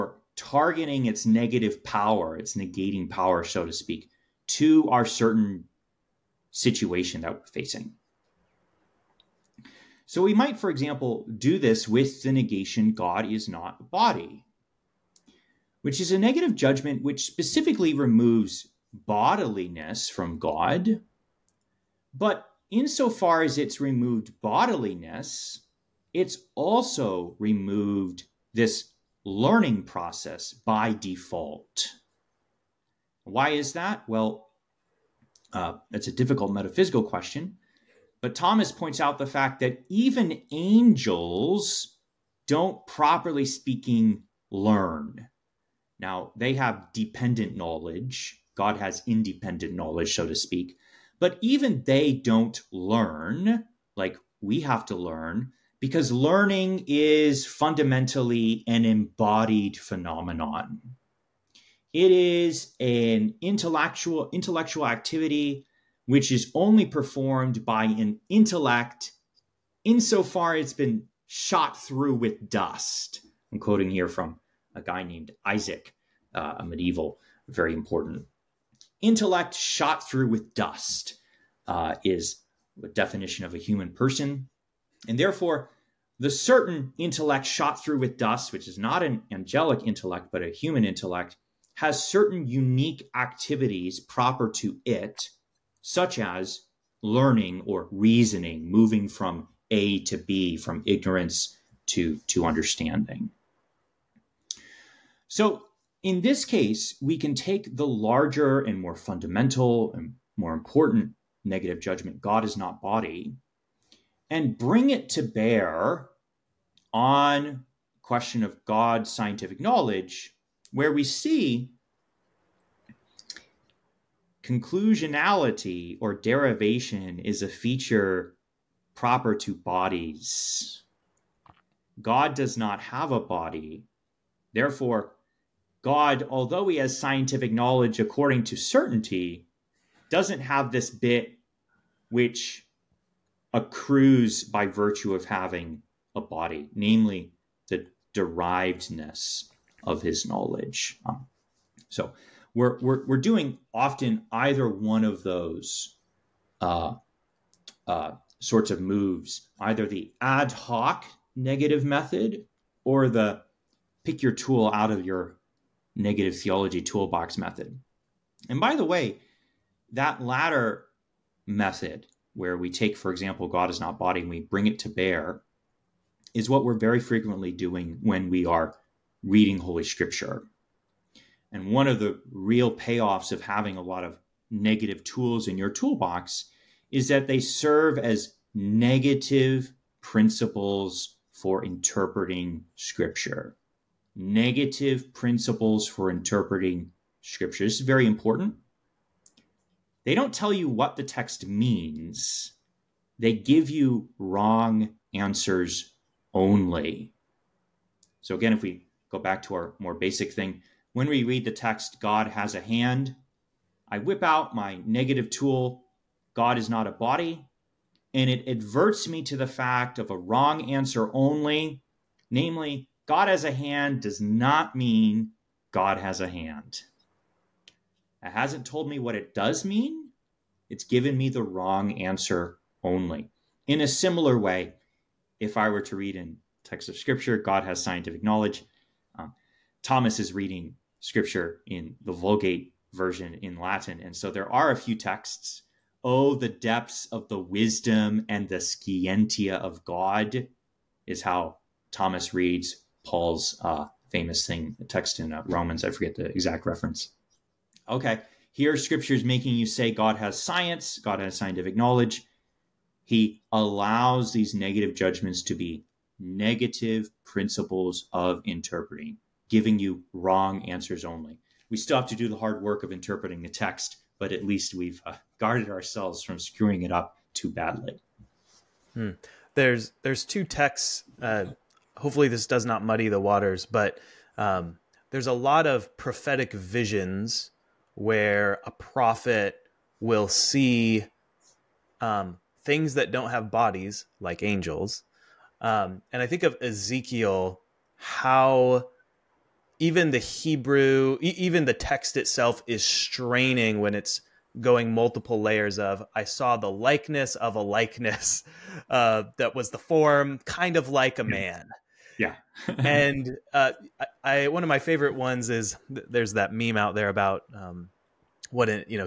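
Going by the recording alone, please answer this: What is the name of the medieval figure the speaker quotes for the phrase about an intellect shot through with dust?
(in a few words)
Isaac.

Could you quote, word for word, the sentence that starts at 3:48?
It hasn't told me what it does mean.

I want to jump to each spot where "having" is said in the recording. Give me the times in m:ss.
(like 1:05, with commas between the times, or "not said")
2:25, 3:03.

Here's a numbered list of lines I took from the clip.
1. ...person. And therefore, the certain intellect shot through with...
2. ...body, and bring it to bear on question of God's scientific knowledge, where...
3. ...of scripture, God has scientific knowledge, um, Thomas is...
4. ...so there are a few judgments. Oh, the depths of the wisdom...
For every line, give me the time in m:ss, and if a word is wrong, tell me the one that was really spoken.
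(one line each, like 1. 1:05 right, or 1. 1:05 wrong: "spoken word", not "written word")
1. 1:23 right
2. 1:52 right
3. 3:56 right
4. 4:04 wrong: "texts", not "judgments".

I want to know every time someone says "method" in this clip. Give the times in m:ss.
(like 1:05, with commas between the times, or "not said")
2:41, 2:47, 2:51.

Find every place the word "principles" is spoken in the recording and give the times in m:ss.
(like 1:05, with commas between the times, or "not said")
3:10, 3:15, 4:27.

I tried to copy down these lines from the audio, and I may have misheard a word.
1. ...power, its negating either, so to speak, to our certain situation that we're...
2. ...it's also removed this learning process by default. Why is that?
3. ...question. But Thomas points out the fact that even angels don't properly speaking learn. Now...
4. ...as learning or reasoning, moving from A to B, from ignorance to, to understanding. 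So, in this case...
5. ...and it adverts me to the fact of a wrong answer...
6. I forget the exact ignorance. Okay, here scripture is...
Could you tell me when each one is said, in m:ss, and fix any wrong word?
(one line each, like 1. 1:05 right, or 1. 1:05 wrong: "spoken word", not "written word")
1. 0:01 wrong: "power", not "either"
2. 0:26 right
3. 0:37 right
4. 1:36 right
5. 3:38 right
6. 4:15 wrong: "reference", not "ignorance".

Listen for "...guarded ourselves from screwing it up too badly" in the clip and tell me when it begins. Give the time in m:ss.
4:35.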